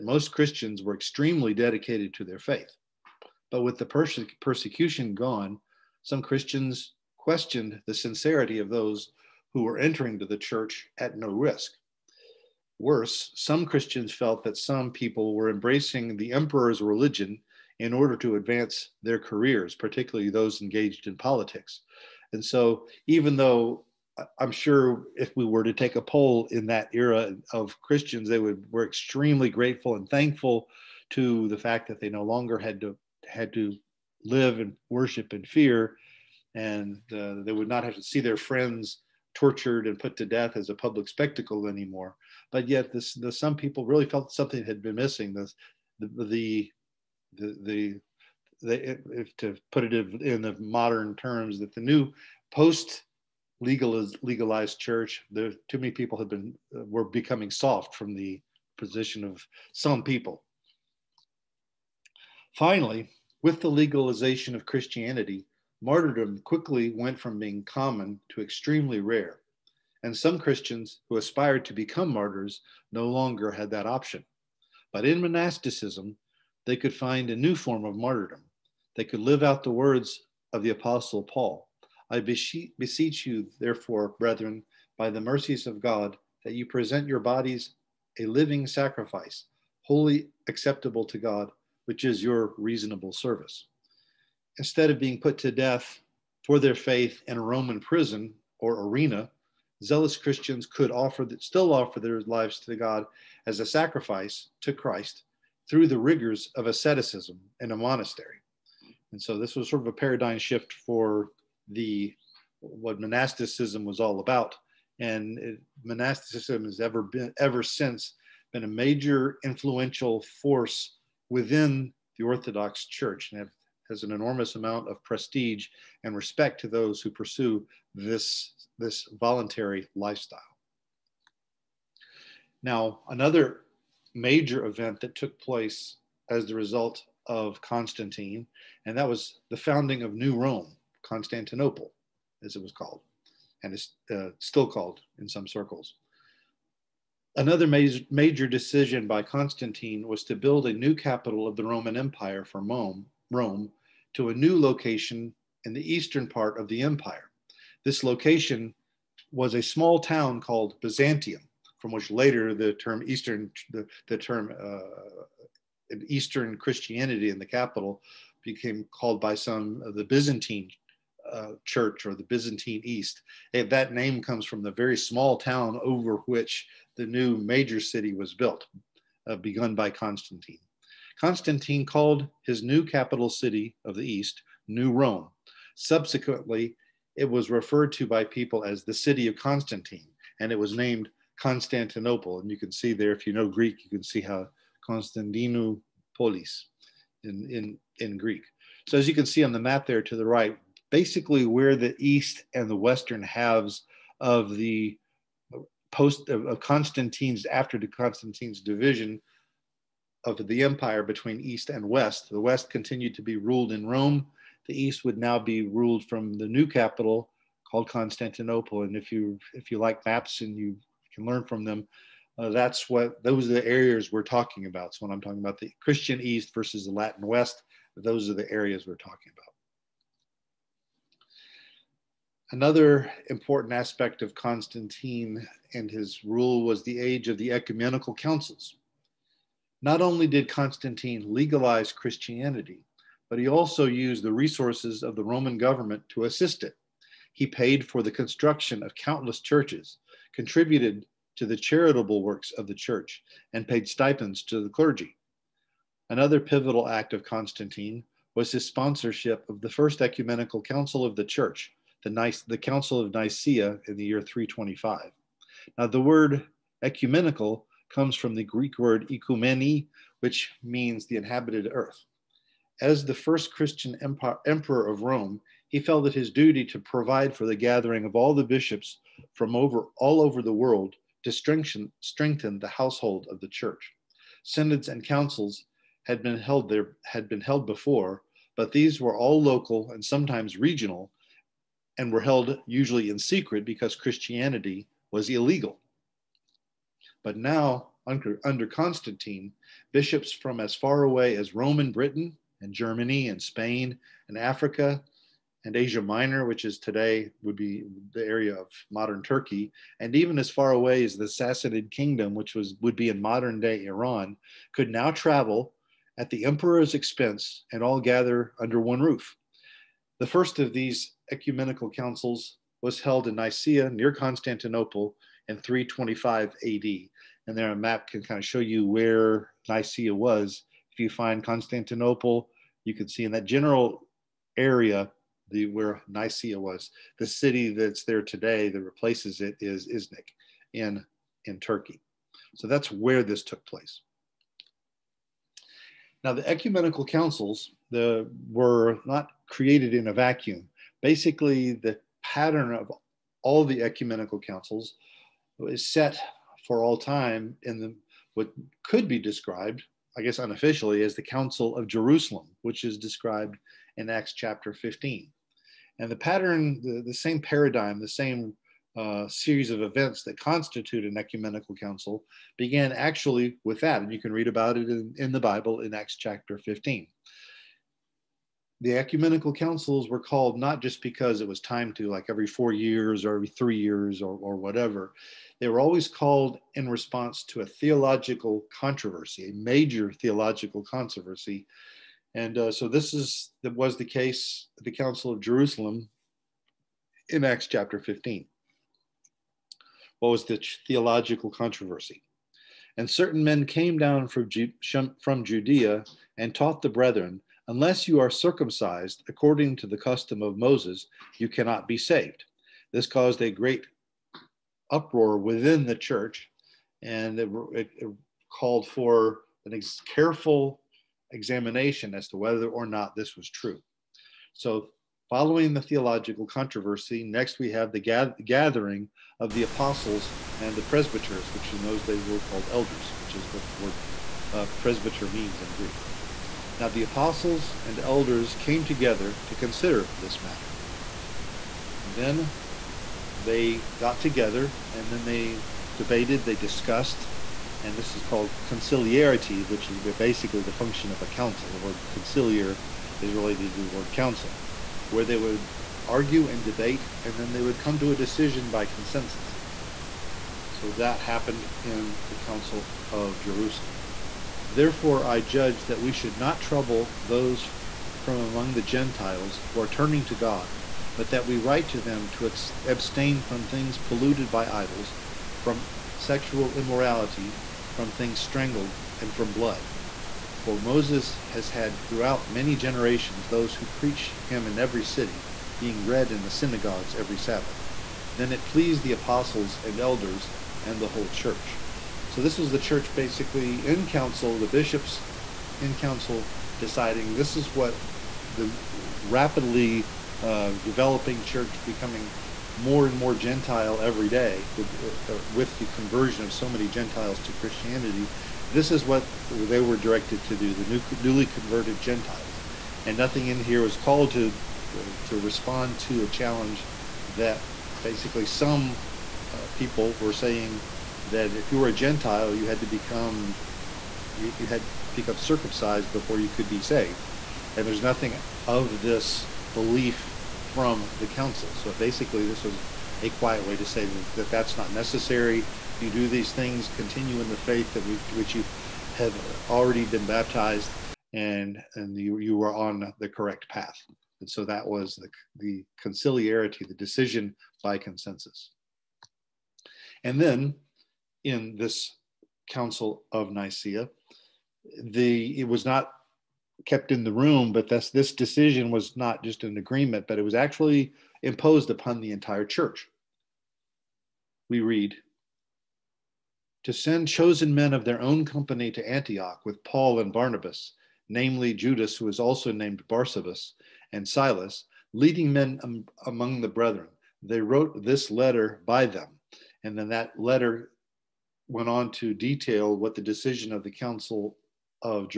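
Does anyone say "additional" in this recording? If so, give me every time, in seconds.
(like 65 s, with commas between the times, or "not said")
not said.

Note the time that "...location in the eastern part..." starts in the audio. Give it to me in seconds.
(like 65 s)
154 s.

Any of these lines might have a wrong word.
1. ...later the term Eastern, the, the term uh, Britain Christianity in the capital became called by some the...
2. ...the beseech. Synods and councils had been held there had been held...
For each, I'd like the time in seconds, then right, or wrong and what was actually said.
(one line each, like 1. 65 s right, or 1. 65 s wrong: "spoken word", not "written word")
1. 162 s wrong: "Eastern", not "Britain"
2. 283 s wrong: "church", not "beseech".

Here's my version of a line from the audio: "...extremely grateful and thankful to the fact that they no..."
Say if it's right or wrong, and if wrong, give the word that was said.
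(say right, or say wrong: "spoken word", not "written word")
right.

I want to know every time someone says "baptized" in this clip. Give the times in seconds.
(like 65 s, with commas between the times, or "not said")
540 s.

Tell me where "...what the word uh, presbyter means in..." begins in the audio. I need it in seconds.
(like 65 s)
433 s.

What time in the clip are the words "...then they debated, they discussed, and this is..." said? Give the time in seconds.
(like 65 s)
445 s.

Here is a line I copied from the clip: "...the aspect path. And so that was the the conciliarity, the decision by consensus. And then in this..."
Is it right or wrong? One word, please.
wrong.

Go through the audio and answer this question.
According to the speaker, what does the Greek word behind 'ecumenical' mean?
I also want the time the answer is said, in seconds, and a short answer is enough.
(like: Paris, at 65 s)
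the inhabited earth, at 271 s.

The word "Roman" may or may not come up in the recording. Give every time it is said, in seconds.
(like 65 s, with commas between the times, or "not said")
97 s, 151 s, 245 s.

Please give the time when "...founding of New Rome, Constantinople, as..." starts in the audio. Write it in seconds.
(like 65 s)
139 s.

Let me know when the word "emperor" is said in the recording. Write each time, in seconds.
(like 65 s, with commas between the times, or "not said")
16 s, 274 s, 316 s.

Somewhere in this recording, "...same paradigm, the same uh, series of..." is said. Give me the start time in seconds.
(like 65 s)
367 s.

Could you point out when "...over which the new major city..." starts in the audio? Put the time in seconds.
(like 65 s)
175 s.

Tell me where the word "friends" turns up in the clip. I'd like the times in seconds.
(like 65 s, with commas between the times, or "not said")
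38 s.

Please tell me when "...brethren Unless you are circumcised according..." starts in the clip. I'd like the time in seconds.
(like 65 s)
406 s.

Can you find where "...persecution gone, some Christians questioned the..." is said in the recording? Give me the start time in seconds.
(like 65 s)
4 s.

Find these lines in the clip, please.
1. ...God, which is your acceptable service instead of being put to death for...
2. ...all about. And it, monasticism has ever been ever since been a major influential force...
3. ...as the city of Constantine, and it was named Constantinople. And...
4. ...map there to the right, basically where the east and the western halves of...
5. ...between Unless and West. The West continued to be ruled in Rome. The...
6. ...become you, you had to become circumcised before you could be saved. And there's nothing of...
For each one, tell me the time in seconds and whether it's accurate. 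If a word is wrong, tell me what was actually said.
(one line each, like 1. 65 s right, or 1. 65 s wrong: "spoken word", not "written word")
1. 91 s wrong: "reasonable", not "acceptable"
2. 113 s right
3. 188 s right
4. 199 s right
5. 211 s wrong: "East", not "Unless"
6. 522 s right.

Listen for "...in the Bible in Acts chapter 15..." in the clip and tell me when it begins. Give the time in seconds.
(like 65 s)
375 s.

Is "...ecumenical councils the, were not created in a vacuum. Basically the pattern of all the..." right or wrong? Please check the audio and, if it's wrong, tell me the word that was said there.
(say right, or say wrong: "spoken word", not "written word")
right.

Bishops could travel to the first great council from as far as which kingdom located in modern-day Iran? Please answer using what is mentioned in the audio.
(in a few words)
Sassanid kingdom.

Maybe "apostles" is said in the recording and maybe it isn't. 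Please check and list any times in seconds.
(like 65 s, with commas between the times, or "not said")
80 s, 429 s, 437 s, 489 s.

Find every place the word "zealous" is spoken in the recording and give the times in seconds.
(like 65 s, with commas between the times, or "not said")
99 s.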